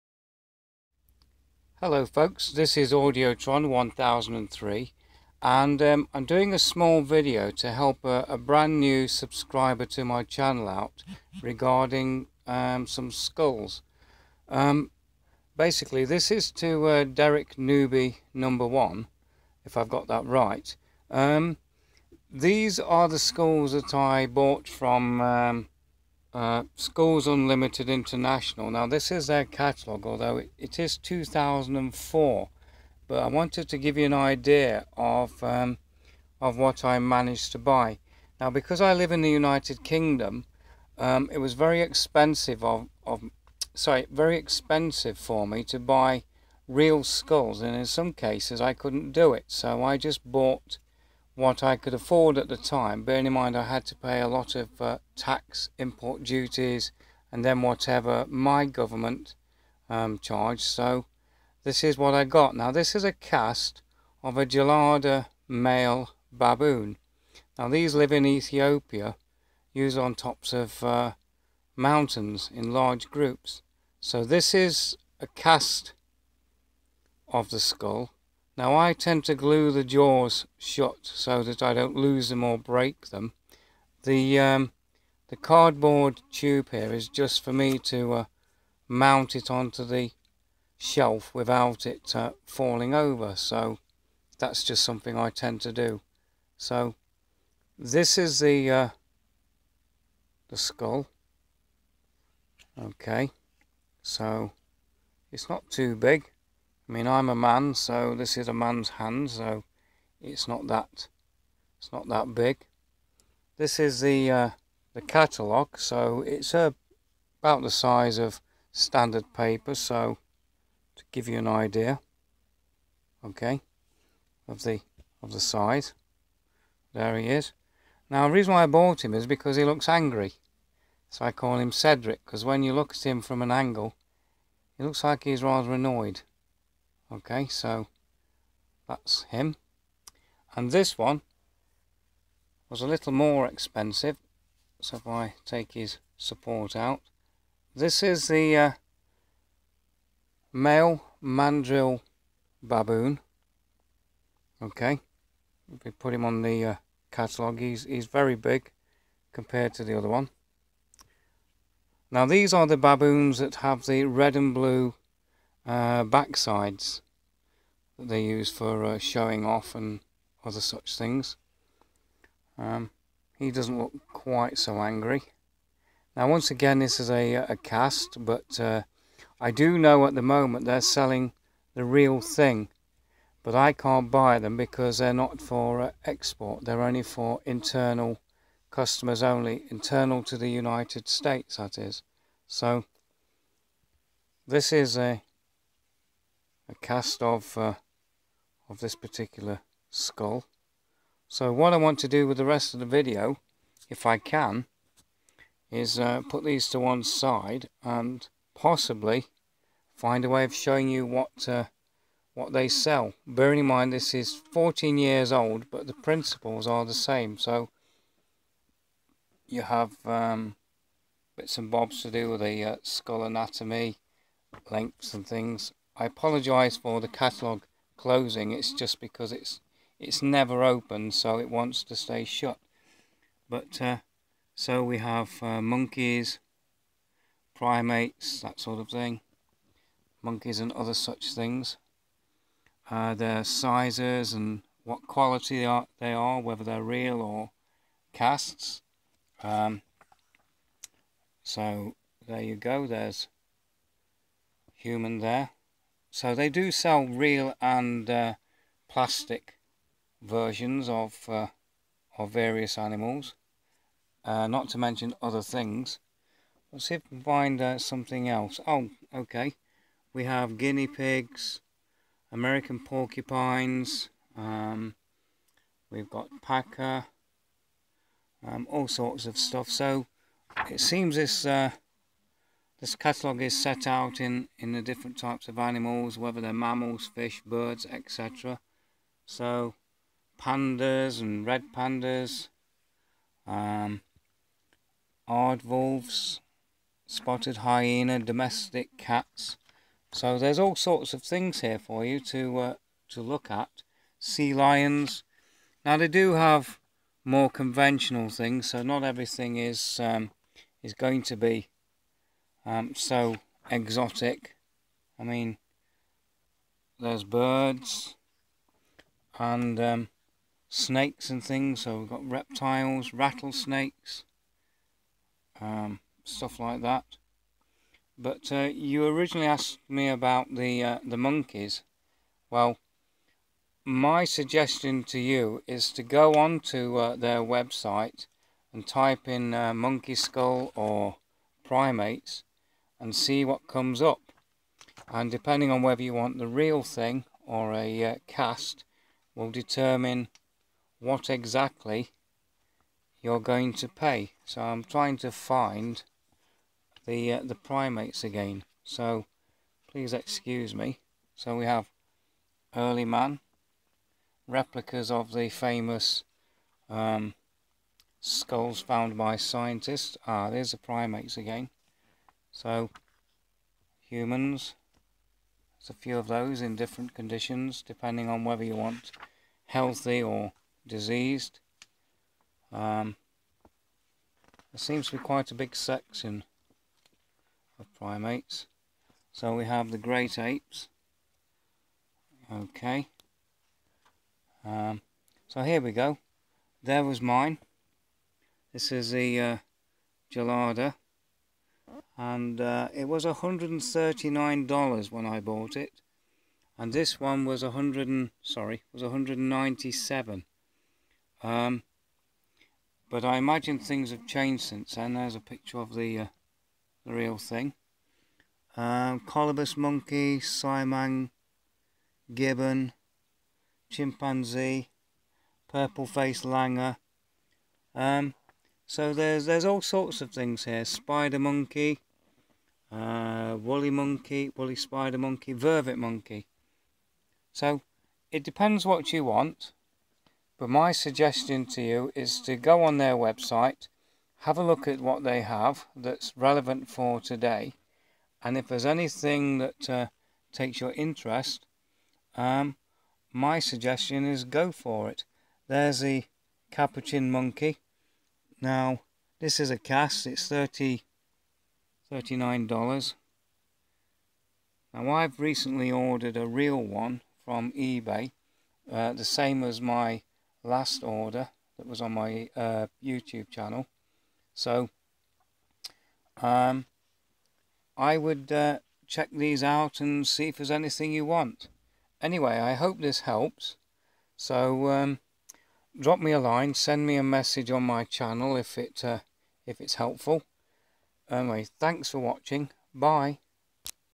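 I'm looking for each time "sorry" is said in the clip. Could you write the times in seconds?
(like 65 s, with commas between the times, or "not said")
43 s, 408 s.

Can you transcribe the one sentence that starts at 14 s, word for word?
Um, basically this is to uh, Derek Newby number one, if I've got that right.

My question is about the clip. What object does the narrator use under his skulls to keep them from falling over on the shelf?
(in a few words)
cardboard tube.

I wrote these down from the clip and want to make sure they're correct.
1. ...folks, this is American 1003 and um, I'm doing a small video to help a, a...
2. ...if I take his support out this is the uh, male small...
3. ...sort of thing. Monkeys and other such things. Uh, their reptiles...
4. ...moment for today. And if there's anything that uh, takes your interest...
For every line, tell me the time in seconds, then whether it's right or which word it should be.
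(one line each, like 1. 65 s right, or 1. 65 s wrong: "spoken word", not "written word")
1. 2 s wrong: "Audiotron", not "American"
2. 144 s wrong: "mandrill", not "small"
3. 238 s wrong: "sizes", not "reptiles"
4. 446 s wrong: "relevant", not "moment".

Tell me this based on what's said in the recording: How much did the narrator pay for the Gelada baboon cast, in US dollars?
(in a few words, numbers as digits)
$139.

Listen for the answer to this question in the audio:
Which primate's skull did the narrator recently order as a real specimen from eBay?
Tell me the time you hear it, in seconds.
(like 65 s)
456 s.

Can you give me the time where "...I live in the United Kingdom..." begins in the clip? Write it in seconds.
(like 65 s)
38 s.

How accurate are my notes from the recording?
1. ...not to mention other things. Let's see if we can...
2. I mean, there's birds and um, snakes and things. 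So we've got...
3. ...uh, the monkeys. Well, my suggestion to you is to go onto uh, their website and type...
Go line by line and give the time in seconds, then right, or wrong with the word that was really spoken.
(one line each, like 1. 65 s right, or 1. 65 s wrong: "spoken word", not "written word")
1. 264 s right
2. 315 s right
3. 330 s right.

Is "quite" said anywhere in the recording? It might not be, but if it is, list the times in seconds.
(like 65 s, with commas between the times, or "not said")
174 s, 385 s.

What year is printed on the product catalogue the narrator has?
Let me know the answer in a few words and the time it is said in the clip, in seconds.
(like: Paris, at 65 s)
2004, at 30 s.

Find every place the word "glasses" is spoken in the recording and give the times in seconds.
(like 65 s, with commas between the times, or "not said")
not said.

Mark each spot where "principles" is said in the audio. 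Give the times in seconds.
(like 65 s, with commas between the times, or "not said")
215 s.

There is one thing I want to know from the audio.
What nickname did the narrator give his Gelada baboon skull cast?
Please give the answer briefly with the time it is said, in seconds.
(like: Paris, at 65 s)
Cedric, at 131 s.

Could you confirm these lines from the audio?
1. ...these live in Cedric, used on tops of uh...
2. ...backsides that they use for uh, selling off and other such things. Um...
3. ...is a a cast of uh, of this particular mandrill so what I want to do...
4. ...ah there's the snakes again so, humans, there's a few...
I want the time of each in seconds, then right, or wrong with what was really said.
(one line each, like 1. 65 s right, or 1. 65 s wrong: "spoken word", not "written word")
1. 67 s wrong: "Ethiopia", not "Cedric"
2. 166 s wrong: "showing", not "selling"
3. 194 s wrong: "skull", not "mandrill"
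4. 370 s wrong: "primates", not "snakes".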